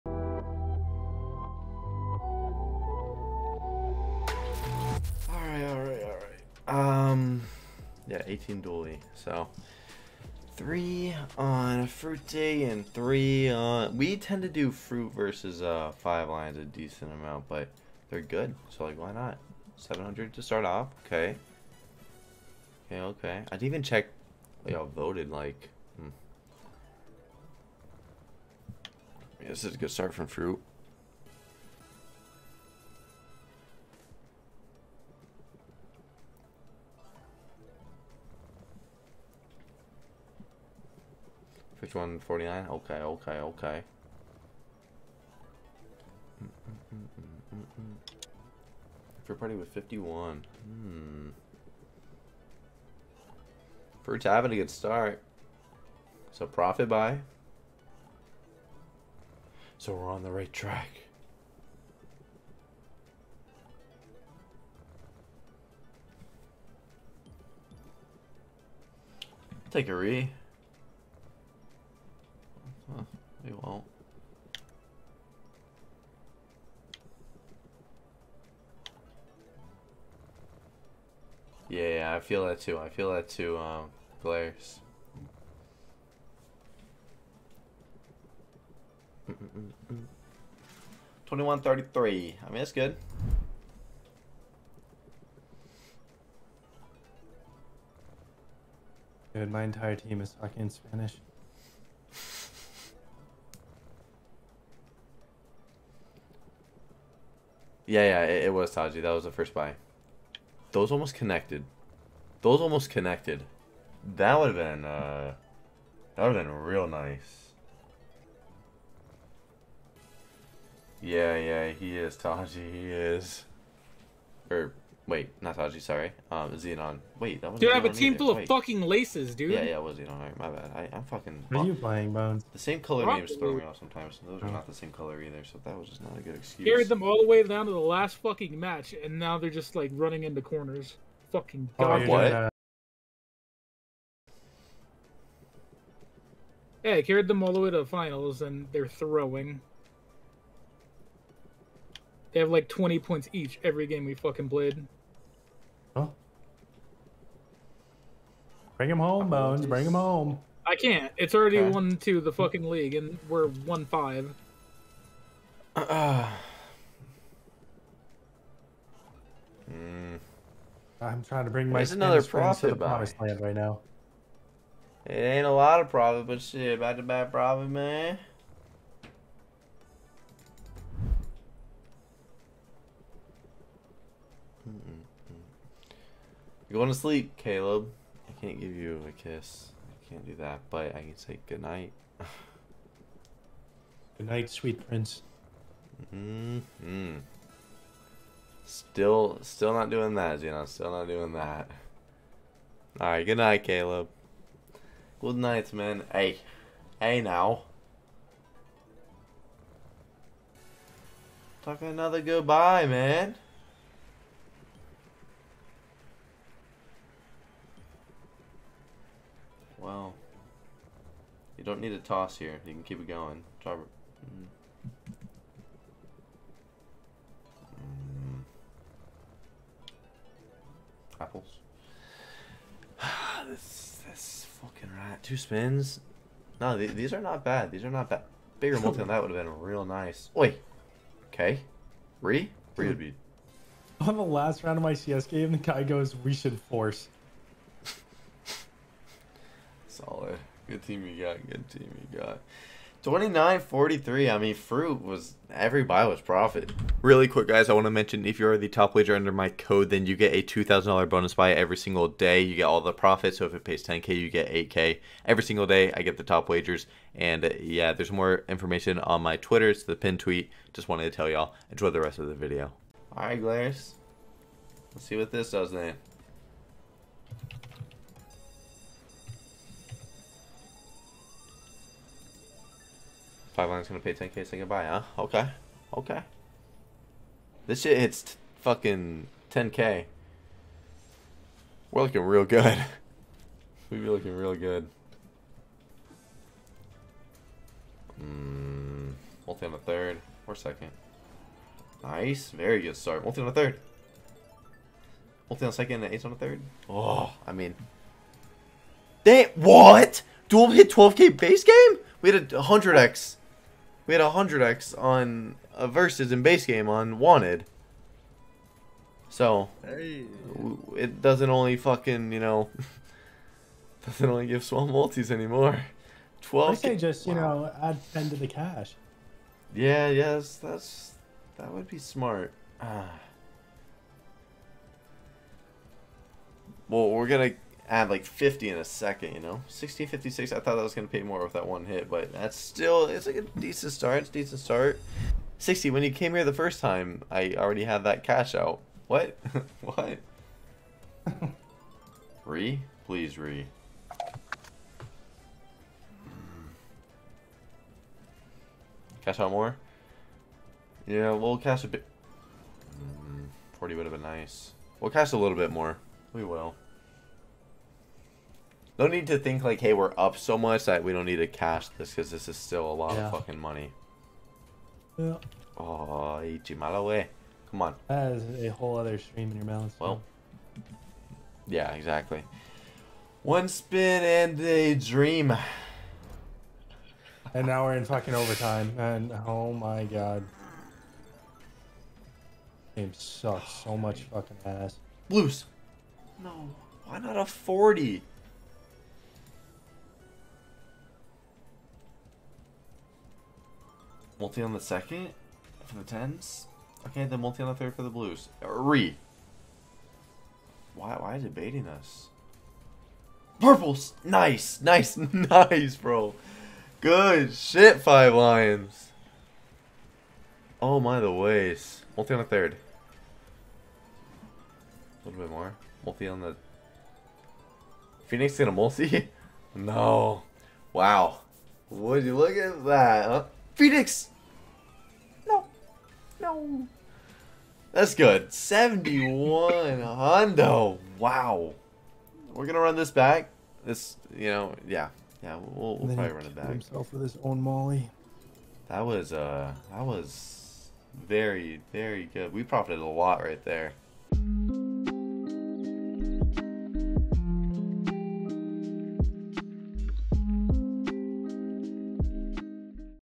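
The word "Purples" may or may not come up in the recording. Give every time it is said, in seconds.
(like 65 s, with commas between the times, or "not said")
413 s.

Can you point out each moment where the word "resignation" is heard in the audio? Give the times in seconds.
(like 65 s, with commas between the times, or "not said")
not said.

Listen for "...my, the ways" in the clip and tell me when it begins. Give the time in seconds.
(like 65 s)
420 s.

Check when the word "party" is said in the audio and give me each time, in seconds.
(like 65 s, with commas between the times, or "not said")
49 s.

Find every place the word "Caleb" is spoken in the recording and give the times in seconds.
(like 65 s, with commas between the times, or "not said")
187 s, 203 s.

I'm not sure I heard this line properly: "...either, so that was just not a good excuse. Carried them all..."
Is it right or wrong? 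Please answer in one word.
right.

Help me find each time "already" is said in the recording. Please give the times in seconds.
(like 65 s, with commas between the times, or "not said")
161 s, 347 s.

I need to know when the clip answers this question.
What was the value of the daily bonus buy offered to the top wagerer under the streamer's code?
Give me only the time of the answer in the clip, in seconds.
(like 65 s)
260 s.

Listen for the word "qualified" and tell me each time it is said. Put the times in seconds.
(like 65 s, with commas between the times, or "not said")
not said.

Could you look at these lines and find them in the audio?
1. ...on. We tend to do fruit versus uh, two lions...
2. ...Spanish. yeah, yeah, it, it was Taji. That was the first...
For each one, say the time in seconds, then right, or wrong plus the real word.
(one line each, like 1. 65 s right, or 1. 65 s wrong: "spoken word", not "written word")
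1. 13 s wrong: "five", not "two"
2. 100 s right.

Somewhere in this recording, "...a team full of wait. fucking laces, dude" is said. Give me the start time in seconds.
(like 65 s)
127 s.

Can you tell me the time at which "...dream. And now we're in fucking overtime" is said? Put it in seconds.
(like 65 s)
384 s.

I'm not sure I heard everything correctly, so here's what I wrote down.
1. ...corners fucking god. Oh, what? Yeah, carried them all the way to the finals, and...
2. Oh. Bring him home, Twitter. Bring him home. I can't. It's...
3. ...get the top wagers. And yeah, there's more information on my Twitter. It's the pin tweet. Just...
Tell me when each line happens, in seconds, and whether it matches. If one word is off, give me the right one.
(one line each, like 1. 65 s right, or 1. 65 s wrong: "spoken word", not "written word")
1. 140 s right
2. 155 s wrong: "Bones", not "Twitter"
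3. 266 s right.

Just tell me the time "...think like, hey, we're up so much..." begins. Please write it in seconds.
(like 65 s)
369 s.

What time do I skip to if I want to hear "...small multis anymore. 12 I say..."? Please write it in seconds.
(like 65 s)
324 s.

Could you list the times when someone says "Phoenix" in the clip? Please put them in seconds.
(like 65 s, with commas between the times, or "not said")
428 s, 433 s.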